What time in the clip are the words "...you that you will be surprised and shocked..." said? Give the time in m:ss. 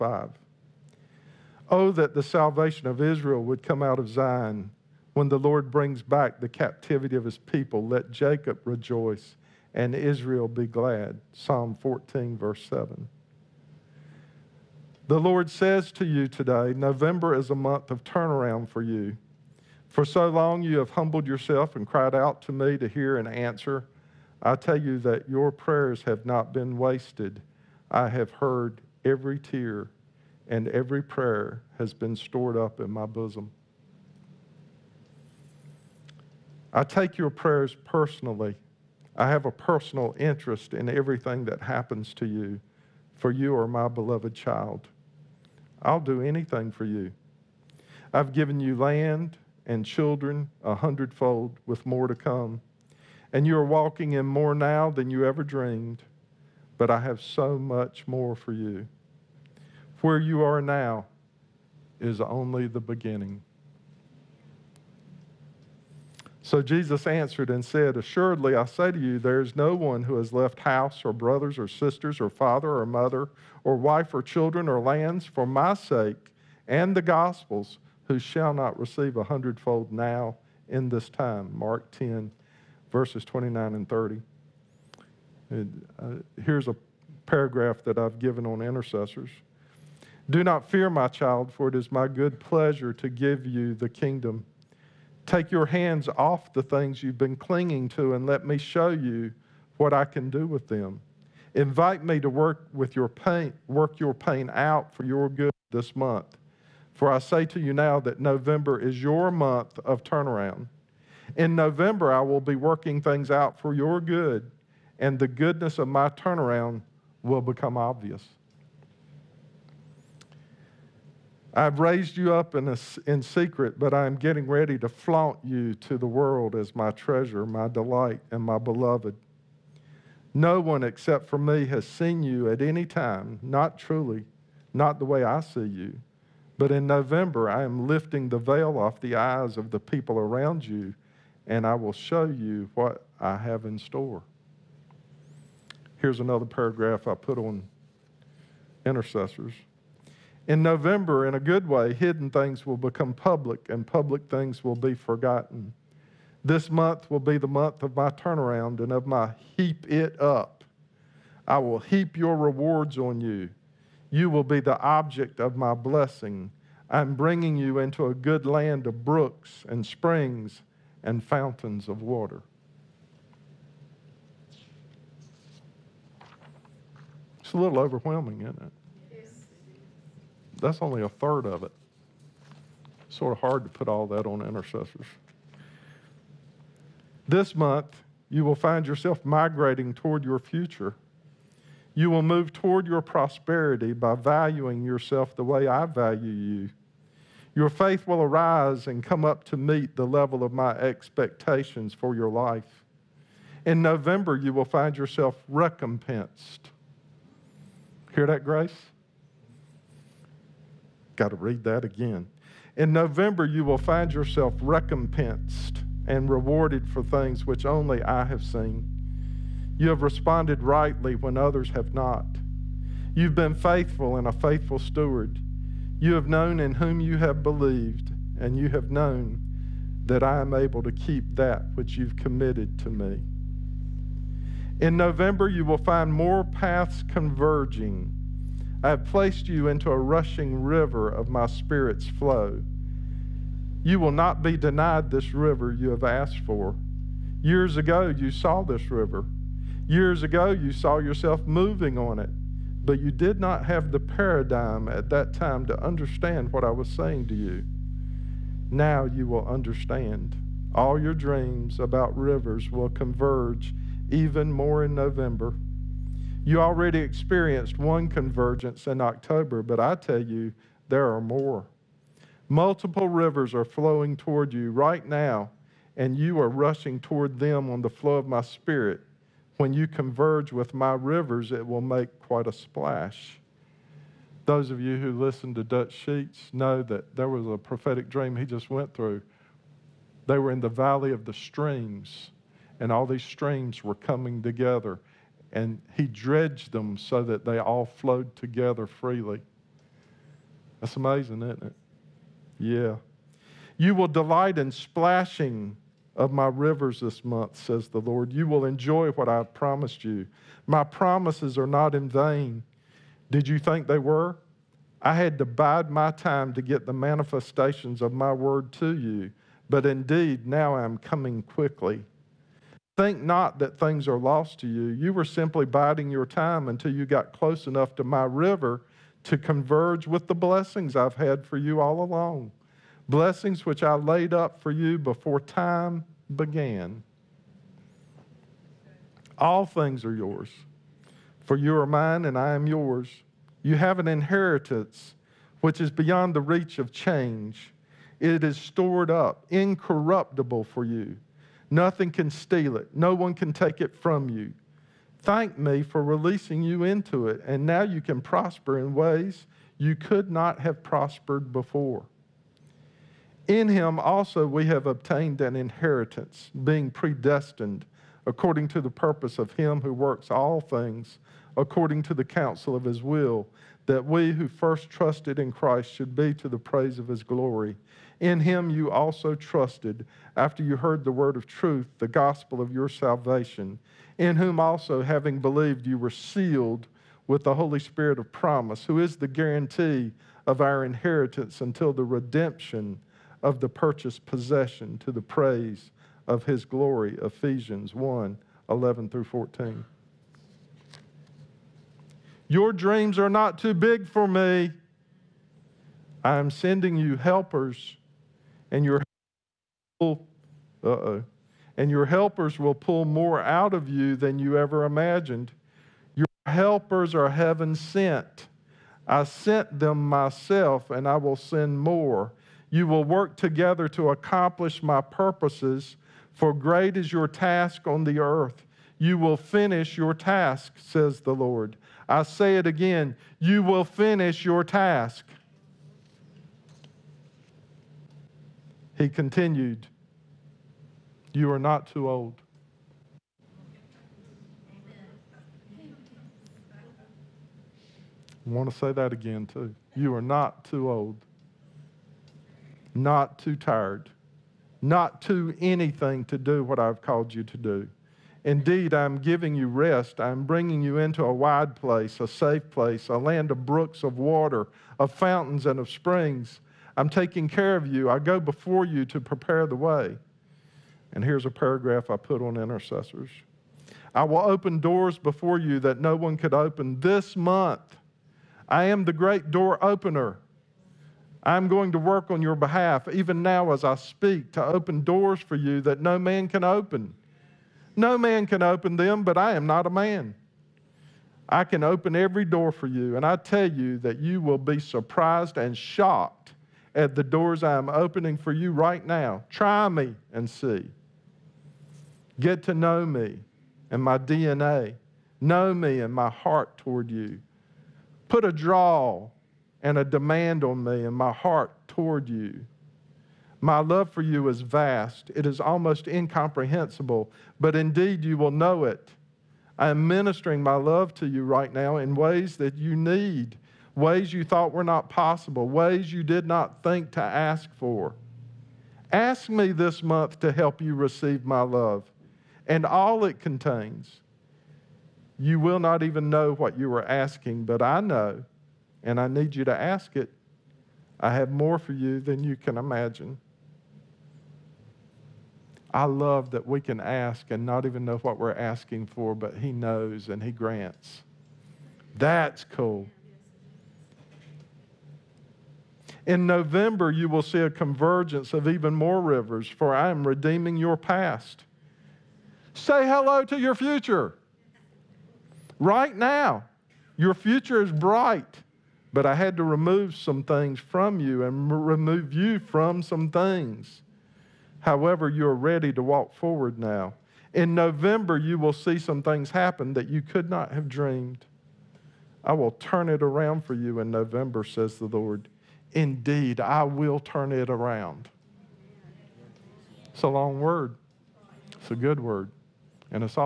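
8:13.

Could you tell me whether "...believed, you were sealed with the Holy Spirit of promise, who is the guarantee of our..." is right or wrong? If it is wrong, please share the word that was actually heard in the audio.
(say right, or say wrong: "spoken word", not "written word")
right.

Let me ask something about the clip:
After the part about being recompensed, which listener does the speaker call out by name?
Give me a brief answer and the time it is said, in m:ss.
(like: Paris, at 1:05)
Grace, at 3:28.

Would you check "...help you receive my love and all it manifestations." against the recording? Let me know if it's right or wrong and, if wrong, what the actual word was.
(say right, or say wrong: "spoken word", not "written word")
wrong: "contains", not "manifestations".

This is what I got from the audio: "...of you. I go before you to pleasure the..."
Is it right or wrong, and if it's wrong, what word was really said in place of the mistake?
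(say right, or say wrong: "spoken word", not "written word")
wrong: "prepare", not "pleasure".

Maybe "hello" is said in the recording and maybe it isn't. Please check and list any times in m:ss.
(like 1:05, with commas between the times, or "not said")
9:23.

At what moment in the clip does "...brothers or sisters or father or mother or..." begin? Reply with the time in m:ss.
1:11.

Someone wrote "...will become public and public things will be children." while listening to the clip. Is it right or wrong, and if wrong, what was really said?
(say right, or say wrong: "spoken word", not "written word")
wrong: "forgotten", not "children".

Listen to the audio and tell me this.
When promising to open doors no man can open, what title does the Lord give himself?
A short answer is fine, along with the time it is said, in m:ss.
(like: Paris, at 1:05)
the great door opener, at 7:59.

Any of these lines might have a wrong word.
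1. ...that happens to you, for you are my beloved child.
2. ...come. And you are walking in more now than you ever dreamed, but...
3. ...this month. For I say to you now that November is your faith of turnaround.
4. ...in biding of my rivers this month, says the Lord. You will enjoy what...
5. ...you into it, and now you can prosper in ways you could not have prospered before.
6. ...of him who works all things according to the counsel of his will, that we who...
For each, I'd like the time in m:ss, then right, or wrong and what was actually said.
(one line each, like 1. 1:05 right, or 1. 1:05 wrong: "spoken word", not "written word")
1. 0:41 right
2. 0:52 right
3. 1:45 wrong: "month", not "faith"
4. 5:04 wrong: "splashing", not "biding"
5. 5:56 right
6. 6:09 right.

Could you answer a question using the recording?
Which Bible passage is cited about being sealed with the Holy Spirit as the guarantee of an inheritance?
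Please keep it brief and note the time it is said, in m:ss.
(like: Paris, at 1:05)
Ephesians 1:11-14, at 6:37.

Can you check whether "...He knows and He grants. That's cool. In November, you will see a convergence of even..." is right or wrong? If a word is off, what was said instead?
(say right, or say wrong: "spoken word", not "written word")
right.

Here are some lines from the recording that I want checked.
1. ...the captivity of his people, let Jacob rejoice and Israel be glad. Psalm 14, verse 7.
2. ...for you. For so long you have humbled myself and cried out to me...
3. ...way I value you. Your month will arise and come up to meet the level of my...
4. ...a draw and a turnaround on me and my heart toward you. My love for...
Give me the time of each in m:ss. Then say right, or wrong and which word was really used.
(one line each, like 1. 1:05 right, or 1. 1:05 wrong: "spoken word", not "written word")
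1. 0:06 right
2. 0:18 wrong: "yourself", not "myself"
3. 3:15 wrong: "faith", not "month"
4. 8:28 wrong: "demand", not "turnaround".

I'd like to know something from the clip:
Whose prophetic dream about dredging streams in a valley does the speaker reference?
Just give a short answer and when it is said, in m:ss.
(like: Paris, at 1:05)
Dutch Sheets, at 4:45.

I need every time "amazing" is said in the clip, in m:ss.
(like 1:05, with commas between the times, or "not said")
5:00.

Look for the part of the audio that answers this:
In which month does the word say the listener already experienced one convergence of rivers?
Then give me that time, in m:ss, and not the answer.
4:28.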